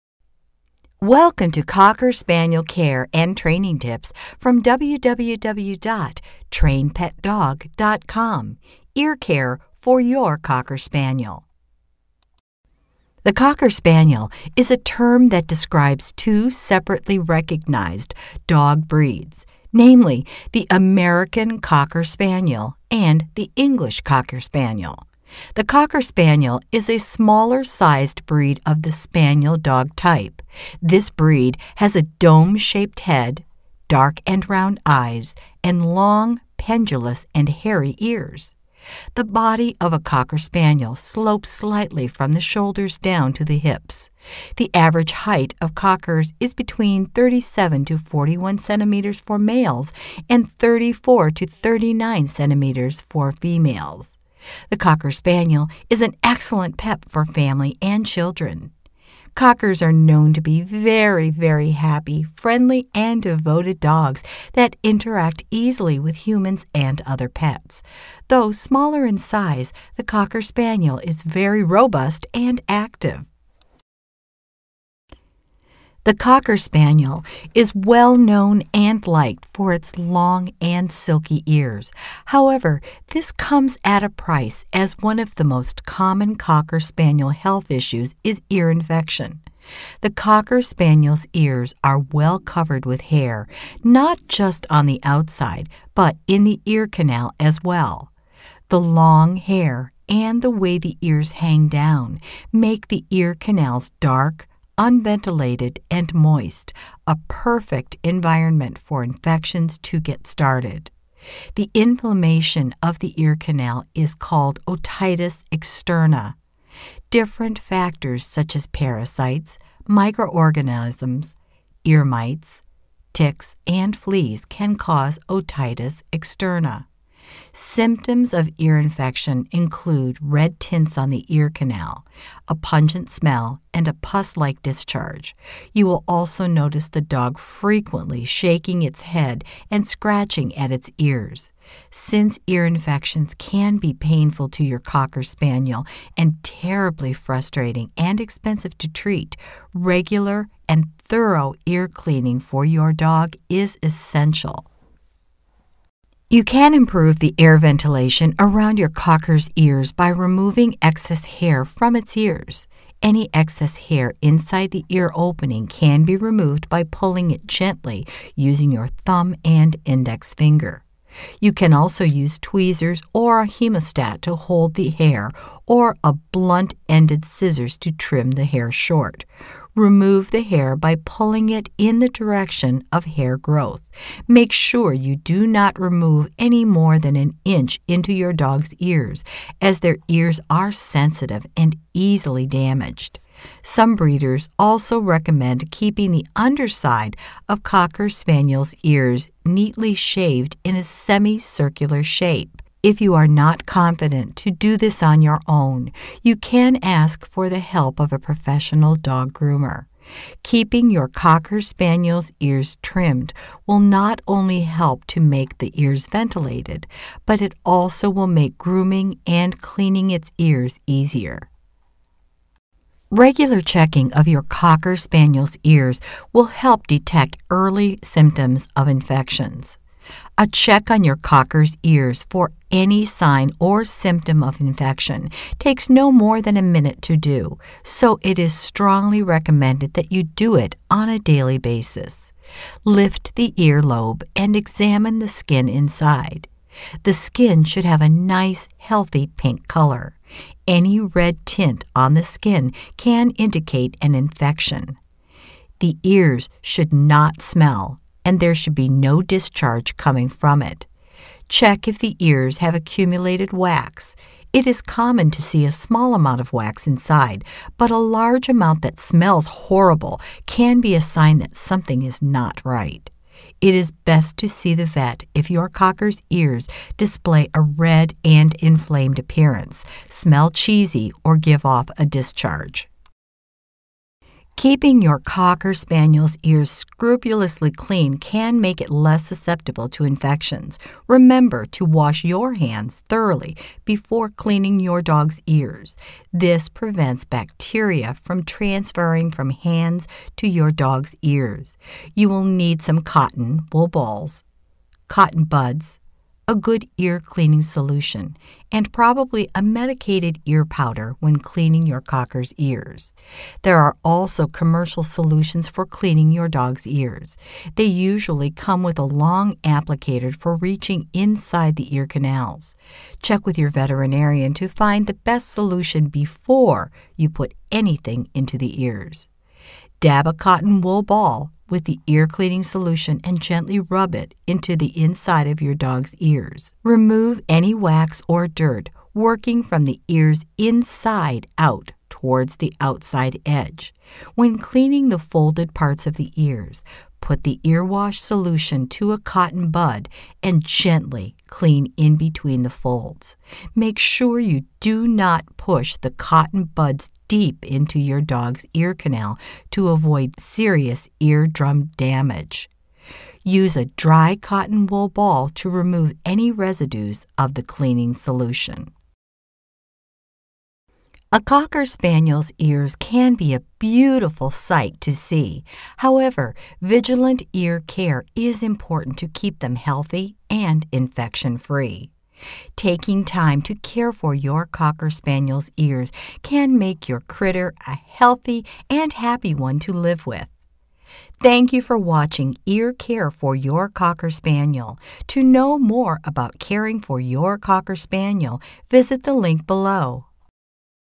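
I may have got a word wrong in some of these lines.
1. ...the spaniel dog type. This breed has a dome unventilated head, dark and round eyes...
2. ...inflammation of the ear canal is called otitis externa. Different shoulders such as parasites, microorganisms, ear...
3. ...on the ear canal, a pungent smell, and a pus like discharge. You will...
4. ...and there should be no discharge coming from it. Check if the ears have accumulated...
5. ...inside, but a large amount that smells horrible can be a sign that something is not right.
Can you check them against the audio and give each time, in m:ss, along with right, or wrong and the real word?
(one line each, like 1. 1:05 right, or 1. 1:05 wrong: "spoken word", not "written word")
1. 0:28 wrong: "shaped", not "unventilated"
2. 1:51 wrong: "factors", not "shoulders"
3. 2:10 right
4. 4:18 right
5. 4:26 right.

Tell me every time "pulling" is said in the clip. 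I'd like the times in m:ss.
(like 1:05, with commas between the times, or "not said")
2:46, 3:00.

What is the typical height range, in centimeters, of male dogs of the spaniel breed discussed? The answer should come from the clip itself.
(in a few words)
37 to 41 centimeters.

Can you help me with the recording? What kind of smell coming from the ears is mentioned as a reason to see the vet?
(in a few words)
cheesy.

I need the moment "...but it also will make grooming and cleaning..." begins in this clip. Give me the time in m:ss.
3:37.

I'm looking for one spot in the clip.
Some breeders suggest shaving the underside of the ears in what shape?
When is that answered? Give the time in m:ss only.
3:20.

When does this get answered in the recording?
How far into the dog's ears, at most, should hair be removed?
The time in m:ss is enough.
3:07.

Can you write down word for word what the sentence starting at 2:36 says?
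You can improve the air ventilation around your cocker's ears by removing excess hair from its ears.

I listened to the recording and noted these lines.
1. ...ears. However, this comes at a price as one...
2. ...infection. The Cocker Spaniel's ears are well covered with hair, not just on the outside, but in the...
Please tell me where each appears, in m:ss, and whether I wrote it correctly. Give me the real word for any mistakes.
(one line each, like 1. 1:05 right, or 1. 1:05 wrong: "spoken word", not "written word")
1. 1:21 right
2. 1:28 right.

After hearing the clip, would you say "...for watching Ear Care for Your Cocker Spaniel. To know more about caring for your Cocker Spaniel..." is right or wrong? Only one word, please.
right.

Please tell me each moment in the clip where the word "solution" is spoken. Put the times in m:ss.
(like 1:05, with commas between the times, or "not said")
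5:07, 5:15, 5:25, 5:32, 5:48, 6:08.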